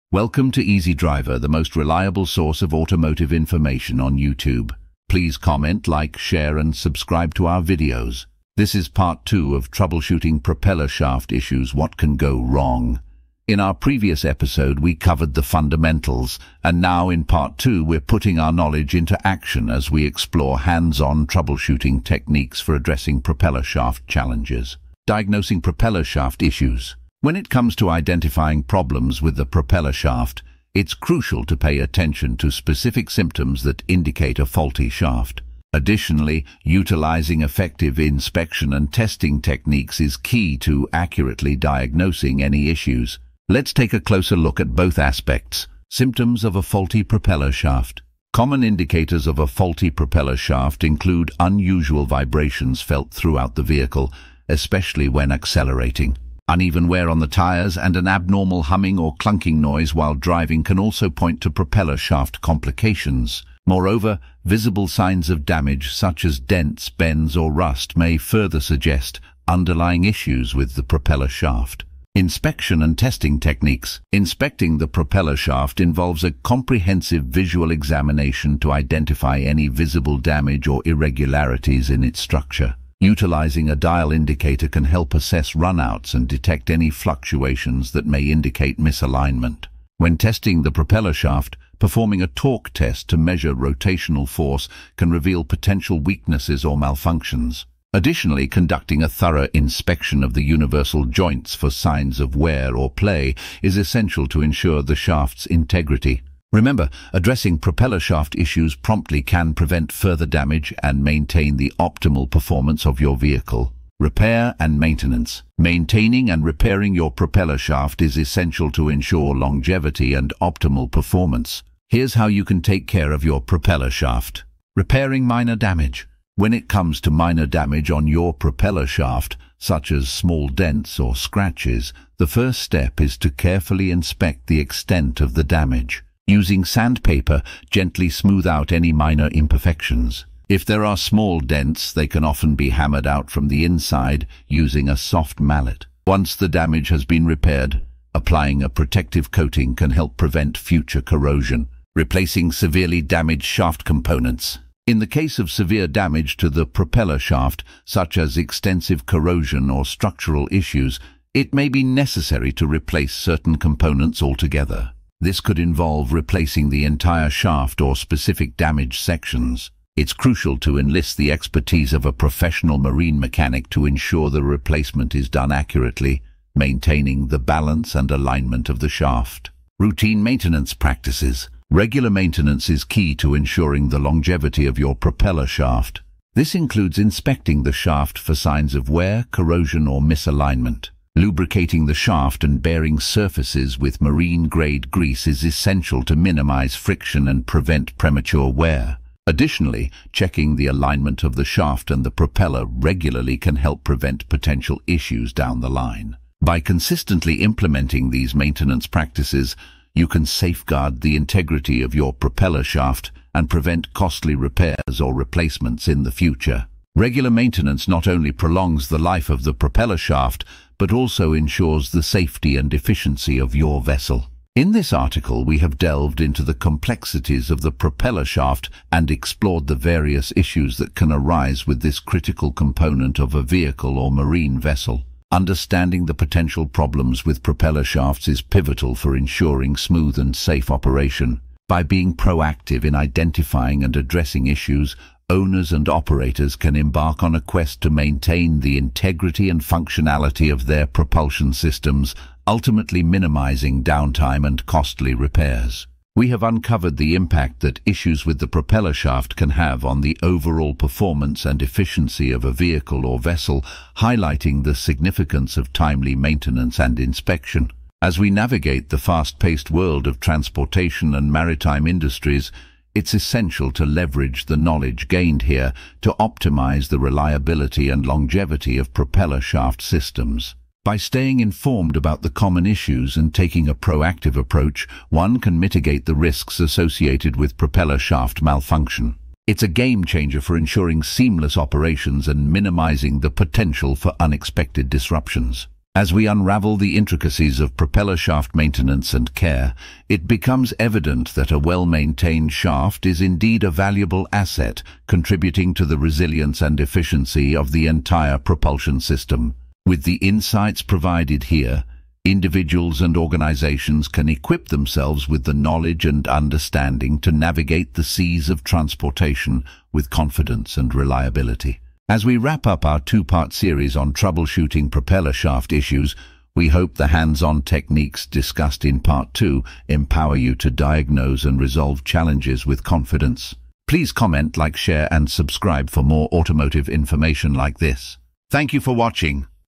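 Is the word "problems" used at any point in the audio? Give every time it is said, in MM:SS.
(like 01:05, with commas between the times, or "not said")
00:28, 03:56.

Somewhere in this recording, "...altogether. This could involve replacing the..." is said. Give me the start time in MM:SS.
02:44.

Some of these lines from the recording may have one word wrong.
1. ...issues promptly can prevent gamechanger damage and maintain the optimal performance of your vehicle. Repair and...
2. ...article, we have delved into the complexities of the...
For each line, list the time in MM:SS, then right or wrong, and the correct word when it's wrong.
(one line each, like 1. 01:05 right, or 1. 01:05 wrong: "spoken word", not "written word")
1. 01:48 wrong: "further", not "gamechanger"
2. 03:44 right.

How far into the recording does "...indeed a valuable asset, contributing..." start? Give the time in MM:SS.
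05:03.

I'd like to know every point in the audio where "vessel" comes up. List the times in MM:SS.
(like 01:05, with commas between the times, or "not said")
03:43, 03:54, 04:23.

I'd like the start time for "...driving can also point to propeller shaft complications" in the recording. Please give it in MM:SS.
01:00.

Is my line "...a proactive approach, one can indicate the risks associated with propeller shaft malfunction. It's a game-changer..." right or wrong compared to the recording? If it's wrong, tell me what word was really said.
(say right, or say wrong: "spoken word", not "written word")
wrong: "mitigate", not "indicate".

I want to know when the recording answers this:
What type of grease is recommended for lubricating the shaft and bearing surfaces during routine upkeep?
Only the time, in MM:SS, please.
03:14.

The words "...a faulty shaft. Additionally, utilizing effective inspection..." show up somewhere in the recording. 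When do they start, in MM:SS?
00:34.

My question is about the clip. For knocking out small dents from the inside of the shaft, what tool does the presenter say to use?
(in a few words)
Soft mallet.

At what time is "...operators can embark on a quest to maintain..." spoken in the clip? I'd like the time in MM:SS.
04:05.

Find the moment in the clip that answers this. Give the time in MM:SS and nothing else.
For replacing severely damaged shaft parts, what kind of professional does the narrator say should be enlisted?
02:52.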